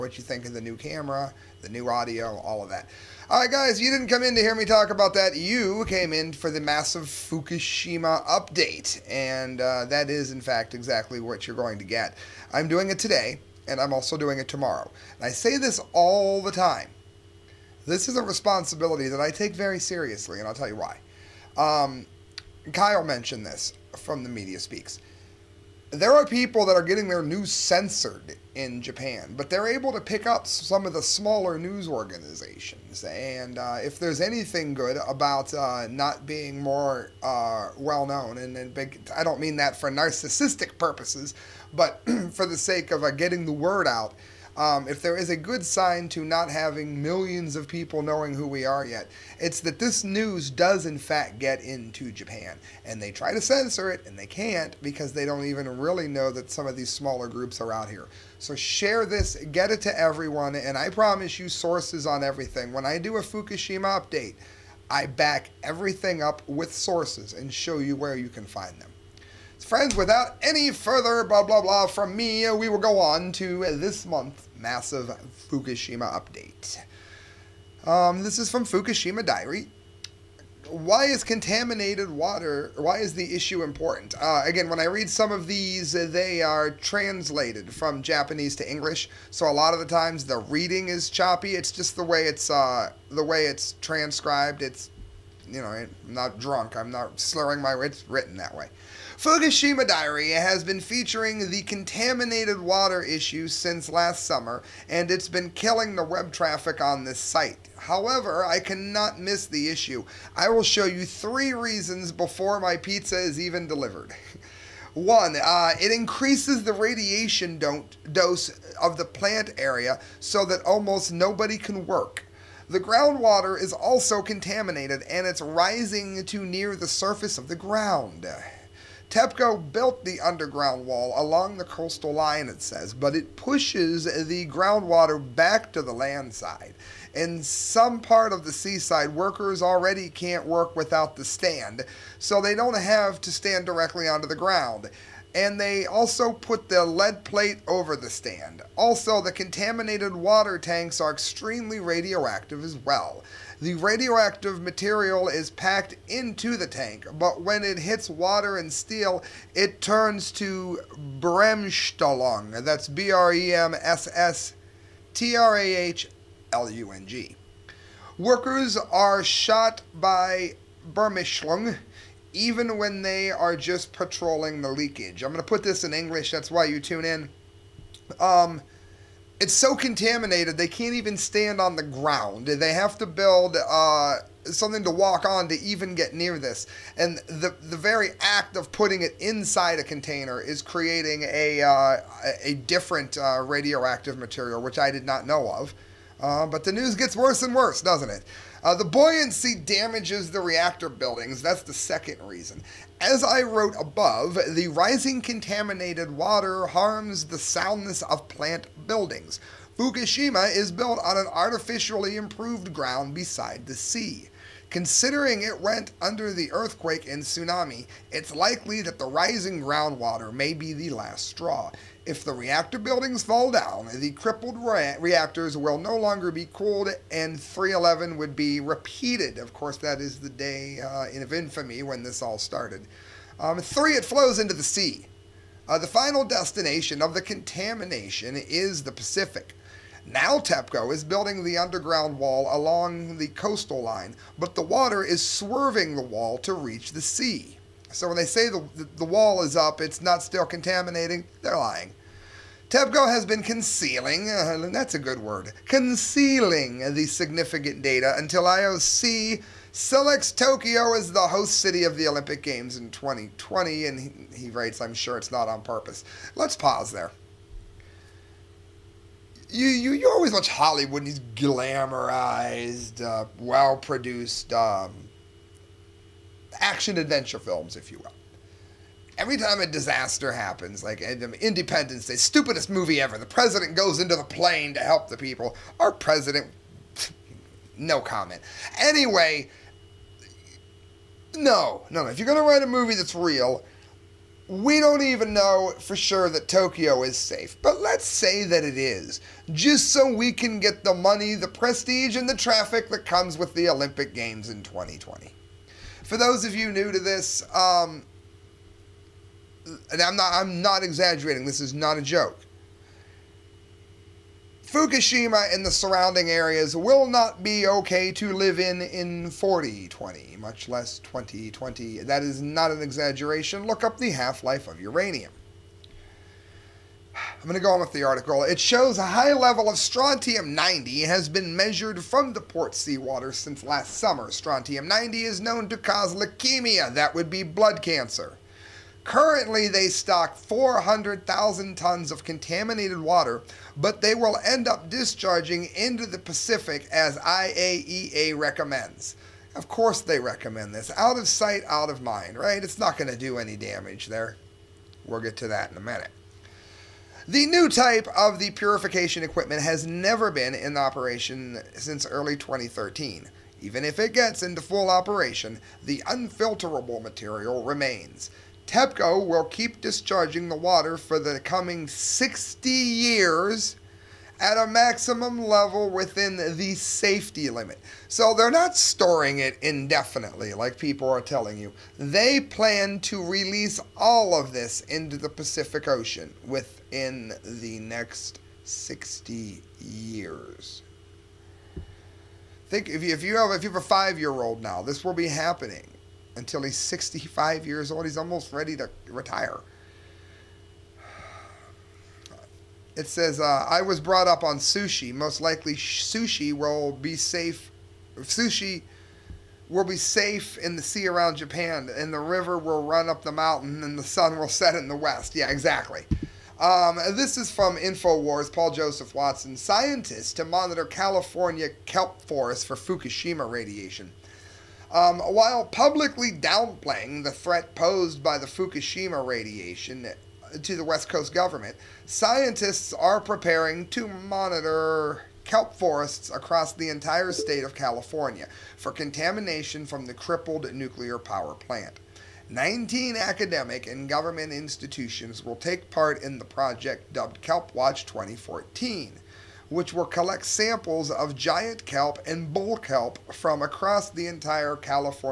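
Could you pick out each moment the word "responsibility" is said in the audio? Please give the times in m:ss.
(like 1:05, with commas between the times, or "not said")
0:18.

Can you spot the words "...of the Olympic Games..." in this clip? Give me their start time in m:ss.
4:21.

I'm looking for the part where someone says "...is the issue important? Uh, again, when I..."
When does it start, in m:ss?
1:22.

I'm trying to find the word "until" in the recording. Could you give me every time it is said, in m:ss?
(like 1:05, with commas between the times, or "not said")
4:18, 6:36.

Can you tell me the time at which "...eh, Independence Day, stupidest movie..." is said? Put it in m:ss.
4:41.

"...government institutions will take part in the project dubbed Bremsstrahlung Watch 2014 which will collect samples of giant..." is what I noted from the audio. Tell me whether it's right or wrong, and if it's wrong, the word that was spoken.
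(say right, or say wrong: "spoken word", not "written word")
wrong: "Kelp", not "Bremsstrahlung".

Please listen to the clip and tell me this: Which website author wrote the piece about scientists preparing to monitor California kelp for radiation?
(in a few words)
Paul Joseph Watson.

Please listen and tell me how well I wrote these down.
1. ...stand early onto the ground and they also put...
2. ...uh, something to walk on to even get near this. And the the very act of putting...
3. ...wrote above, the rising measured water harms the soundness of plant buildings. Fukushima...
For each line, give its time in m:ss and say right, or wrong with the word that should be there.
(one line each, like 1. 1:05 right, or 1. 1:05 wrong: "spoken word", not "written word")
1. 2:23 wrong: "directly", not "early"
2. 3:03 right
3. 3:23 wrong: "contaminated", not "measured".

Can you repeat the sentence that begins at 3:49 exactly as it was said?
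Of course, that is the day uh, of infamy when this all started.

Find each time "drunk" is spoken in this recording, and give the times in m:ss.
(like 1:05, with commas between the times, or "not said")
1:36.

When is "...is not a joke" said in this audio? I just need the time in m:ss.
5:11.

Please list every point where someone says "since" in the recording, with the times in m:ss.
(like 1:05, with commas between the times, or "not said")
1:43, 5:33, 6:01.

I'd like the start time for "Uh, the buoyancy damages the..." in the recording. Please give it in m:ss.
3:18.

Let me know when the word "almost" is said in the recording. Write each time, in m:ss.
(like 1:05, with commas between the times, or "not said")
2:00, 6:38.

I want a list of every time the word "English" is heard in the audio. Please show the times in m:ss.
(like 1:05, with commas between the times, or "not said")
1:28, 2:55.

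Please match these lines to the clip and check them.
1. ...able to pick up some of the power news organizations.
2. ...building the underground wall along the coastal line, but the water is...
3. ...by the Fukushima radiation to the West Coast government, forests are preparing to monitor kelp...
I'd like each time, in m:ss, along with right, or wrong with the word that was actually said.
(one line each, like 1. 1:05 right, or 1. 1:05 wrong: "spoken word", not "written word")
1. 0:29 wrong: "smaller", not "power"
2. 4:01 right
3. 7:08 wrong: "scientists", not "forests".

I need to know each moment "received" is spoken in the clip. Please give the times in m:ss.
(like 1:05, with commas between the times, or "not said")
not said.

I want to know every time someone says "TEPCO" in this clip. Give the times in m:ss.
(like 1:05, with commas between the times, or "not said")
2:09, 4:00, 4:12, 6:08.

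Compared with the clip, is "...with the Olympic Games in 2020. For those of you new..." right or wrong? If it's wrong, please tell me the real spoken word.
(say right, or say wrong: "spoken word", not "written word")
right.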